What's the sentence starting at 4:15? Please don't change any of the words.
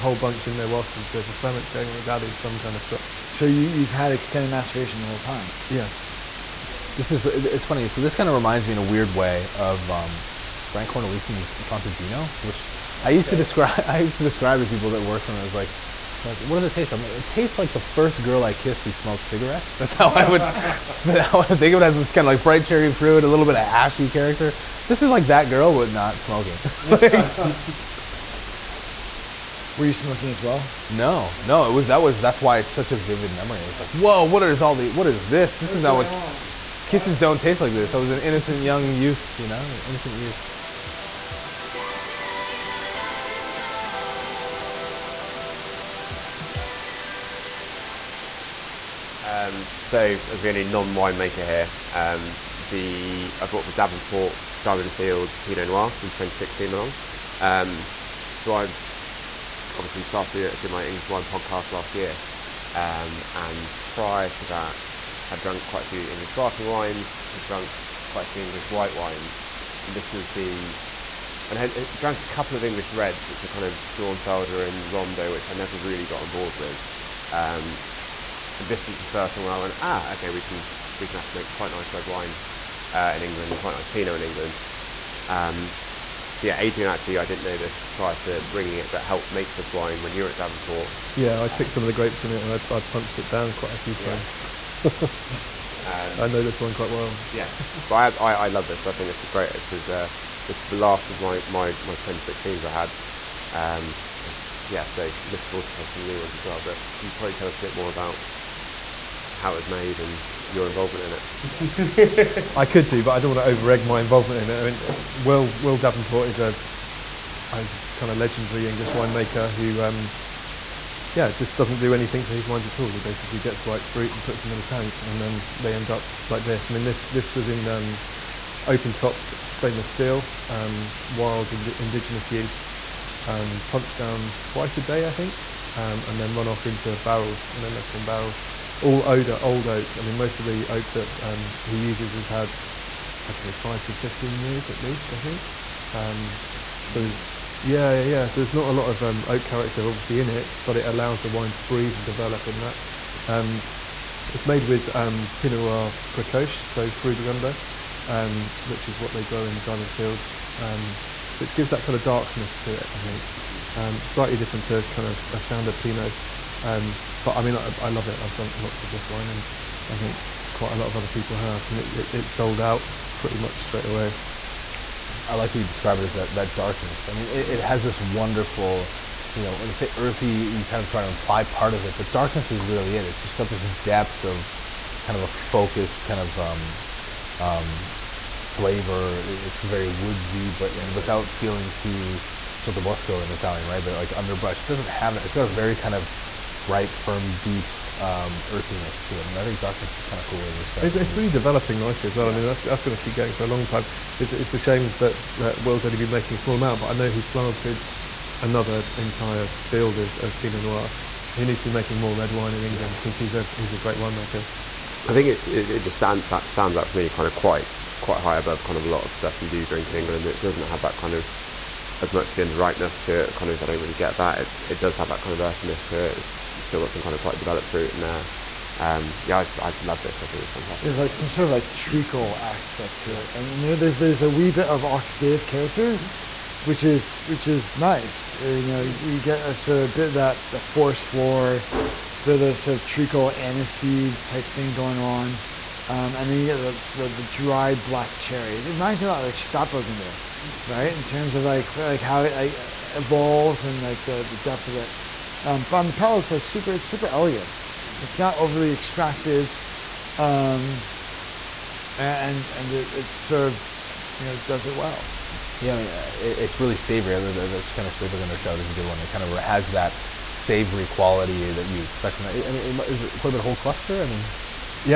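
Um, but on the palate it's like super it's super elegant.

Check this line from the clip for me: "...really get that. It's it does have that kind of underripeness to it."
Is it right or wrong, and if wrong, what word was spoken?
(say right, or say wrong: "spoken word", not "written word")
wrong: "earthiness", not "underripeness".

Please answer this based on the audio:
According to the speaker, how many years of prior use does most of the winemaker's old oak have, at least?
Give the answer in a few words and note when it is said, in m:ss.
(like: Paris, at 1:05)
5 to 15 years, at 2:23.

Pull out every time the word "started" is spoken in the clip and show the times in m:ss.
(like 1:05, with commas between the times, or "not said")
1:00.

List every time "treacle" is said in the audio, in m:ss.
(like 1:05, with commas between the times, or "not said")
3:51, 4:02.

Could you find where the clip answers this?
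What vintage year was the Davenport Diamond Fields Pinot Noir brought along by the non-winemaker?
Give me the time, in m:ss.
0:56.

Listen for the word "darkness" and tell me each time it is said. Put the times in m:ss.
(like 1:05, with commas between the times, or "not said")
2:42, 2:56, 3:02, 3:19.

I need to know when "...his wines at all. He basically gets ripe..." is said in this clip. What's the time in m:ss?
2:02.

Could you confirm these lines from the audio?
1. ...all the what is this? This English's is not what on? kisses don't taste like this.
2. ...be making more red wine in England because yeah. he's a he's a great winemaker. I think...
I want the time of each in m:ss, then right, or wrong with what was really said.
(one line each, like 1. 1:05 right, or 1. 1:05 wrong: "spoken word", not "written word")
1. 0:34 wrong: "What", not "English"
2. 3:31 right.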